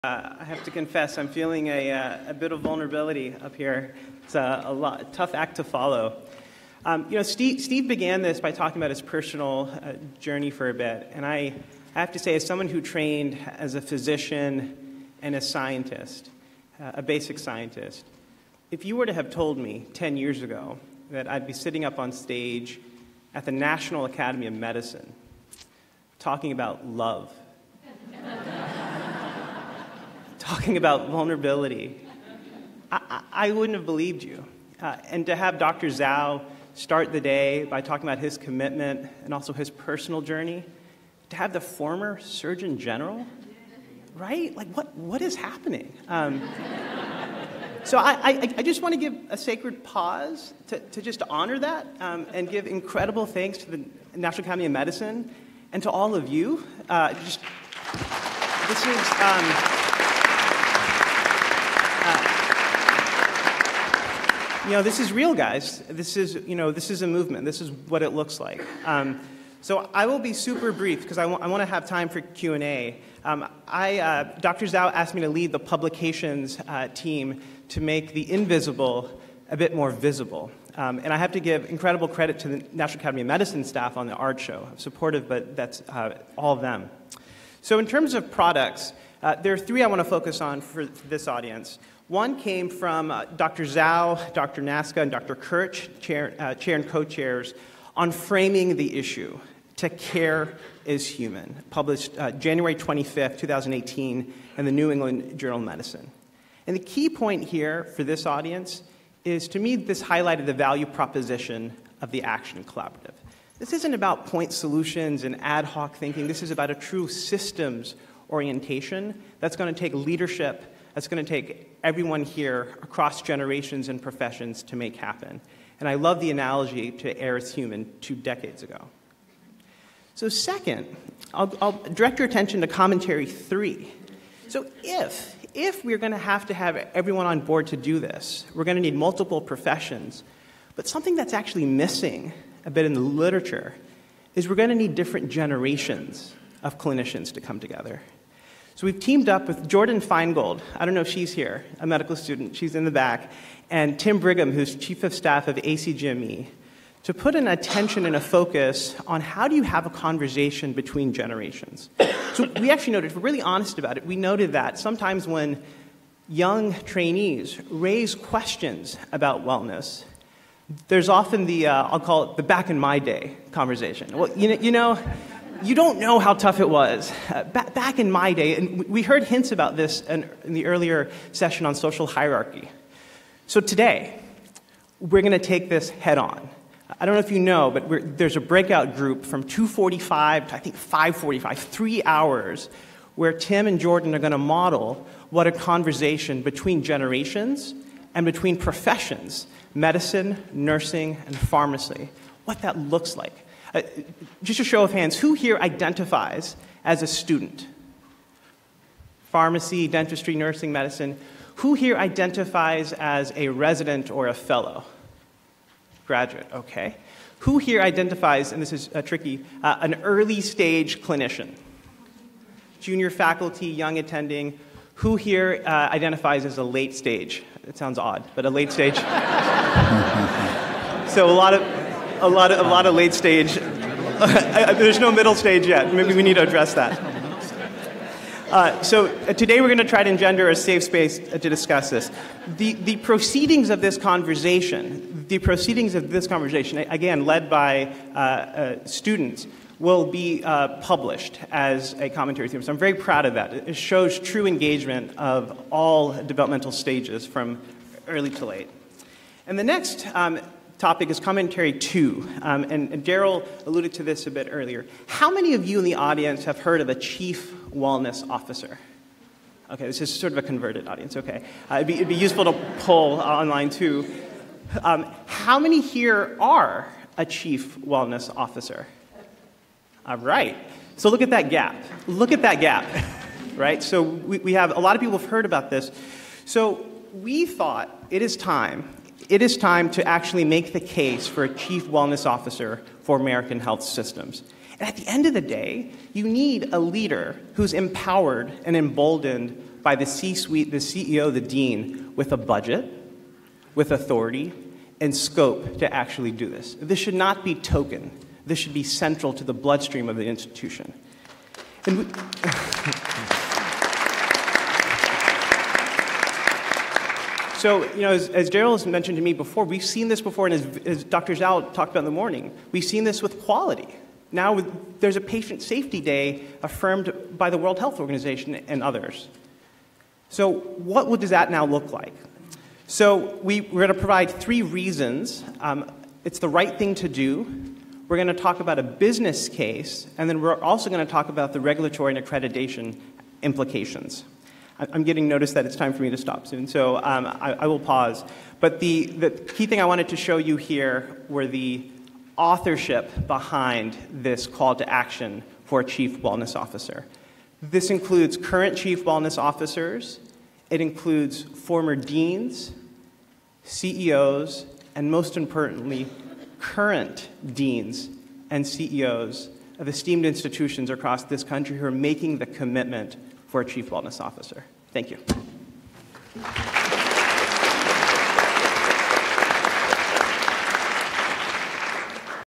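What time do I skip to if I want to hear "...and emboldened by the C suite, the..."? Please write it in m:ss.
4:58.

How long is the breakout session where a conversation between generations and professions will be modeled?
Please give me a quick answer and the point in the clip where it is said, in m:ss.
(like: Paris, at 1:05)
3 hours, at 3:11.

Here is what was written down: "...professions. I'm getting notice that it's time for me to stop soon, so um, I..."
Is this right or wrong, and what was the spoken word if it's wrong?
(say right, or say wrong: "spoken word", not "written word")
wrong: "implications", not "professions".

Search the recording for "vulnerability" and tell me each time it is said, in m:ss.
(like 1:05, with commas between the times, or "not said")
0:02, 0:31.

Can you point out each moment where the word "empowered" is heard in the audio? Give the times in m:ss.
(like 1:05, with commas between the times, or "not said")
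4:57.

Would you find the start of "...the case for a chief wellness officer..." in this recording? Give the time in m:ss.
4:50.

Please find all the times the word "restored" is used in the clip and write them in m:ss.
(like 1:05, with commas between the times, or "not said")
not said.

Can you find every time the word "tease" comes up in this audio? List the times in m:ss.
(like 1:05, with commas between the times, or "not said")
not said.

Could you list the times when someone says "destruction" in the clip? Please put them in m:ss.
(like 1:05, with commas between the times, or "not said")
not said.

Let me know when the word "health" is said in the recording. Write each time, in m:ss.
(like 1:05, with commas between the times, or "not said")
4:53, 5:27.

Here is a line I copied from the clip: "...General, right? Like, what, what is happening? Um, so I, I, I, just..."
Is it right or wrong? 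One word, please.
right.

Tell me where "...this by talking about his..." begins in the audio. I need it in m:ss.
0:08.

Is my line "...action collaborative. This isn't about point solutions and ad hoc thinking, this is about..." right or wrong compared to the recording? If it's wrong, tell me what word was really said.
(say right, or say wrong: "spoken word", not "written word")
right.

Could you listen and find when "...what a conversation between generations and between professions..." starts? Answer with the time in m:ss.
3:15.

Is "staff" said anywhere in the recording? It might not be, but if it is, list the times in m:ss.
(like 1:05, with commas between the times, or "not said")
1:23, 2:35.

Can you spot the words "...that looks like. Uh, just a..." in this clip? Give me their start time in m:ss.
3:22.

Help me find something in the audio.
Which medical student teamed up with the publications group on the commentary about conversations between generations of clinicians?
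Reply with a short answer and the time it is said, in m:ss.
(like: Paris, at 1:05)
Jordyn Feingold, at 2:29.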